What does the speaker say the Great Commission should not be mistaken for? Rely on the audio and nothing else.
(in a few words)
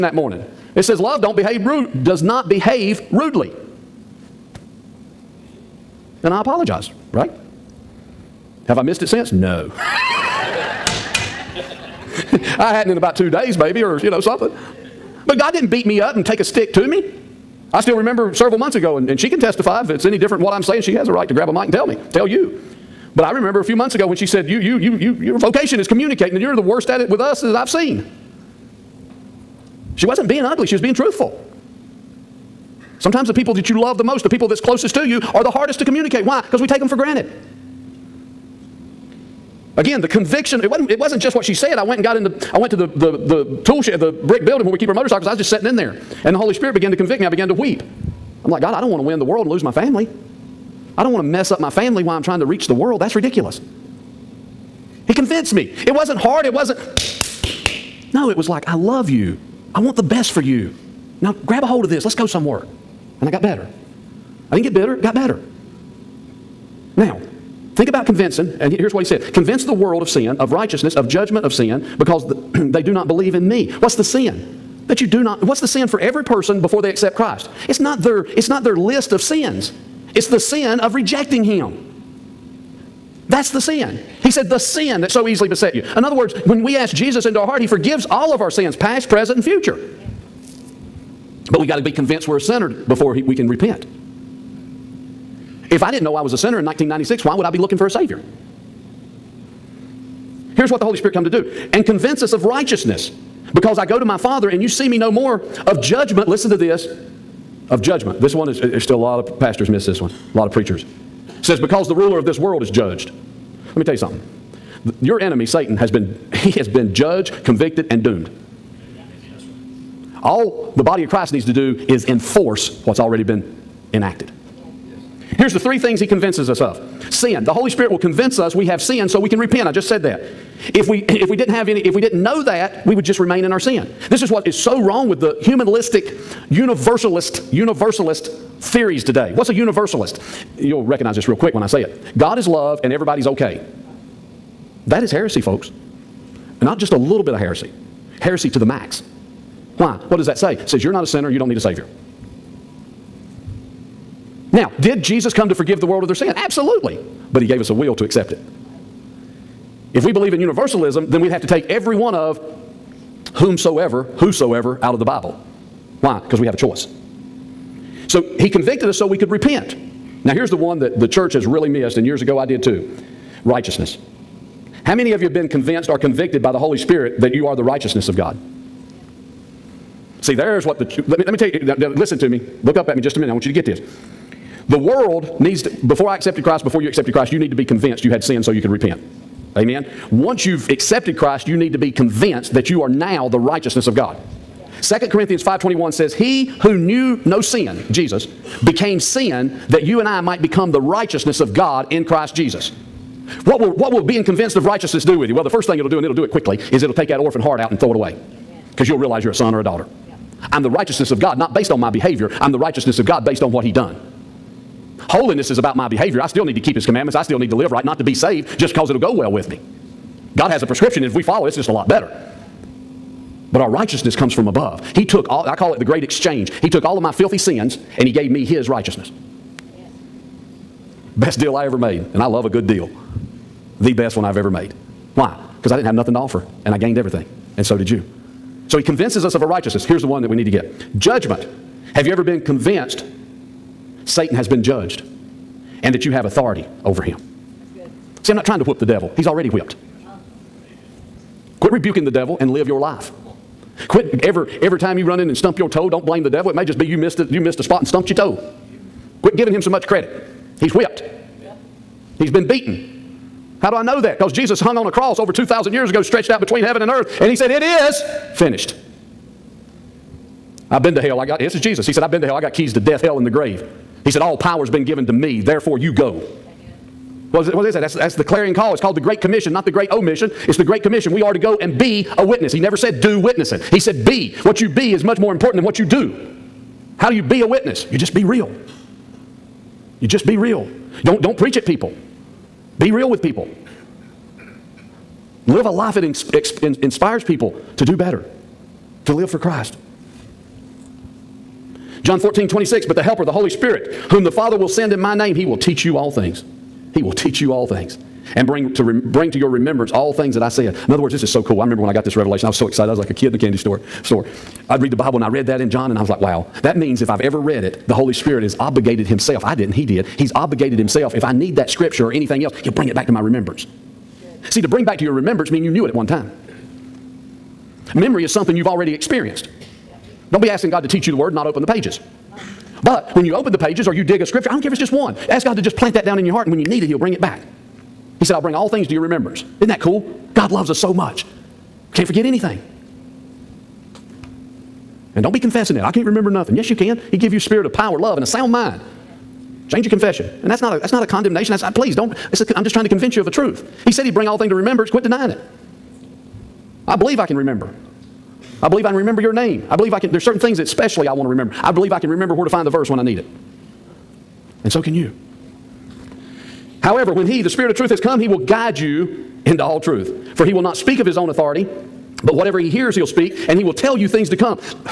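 The Great Omission.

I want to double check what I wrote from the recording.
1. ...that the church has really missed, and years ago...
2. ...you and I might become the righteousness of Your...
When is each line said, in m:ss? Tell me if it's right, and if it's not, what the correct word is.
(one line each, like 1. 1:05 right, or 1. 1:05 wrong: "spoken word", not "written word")
1. 2:50 right
2. 3:19 wrong: "God", not "Your".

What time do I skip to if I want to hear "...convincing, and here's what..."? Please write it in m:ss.
1:08.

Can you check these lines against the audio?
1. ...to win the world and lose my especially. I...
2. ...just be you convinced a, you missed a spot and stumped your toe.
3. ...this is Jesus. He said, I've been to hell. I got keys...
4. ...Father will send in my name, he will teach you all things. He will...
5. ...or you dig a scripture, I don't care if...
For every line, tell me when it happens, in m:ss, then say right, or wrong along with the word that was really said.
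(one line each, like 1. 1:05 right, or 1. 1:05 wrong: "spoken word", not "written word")
1. 0:48 wrong: "family", not "especially"
2. 4:16 wrong: "missed", not "convinced"
3. 4:31 right
4. 5:04 right
5. 5:33 right.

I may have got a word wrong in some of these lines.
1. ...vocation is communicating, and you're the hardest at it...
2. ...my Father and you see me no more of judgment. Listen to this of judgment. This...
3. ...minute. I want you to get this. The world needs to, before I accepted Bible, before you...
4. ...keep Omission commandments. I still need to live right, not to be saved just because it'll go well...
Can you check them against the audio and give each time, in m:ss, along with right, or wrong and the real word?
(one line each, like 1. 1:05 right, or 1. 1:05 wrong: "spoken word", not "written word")
1. 0:25 wrong: "worst", not "hardest"
2. 1:44 right
3. 3:03 wrong: "Christ", not "Bible"
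4. 3:36 wrong: "His", not "Omission".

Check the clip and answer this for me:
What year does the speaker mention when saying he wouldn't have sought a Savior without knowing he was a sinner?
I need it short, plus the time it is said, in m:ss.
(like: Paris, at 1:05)
1996, at 1:36.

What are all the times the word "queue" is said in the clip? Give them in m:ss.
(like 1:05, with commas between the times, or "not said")
not said.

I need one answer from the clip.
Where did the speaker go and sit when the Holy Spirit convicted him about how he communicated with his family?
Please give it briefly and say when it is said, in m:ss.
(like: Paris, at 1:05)
The tool shed, at 0:43.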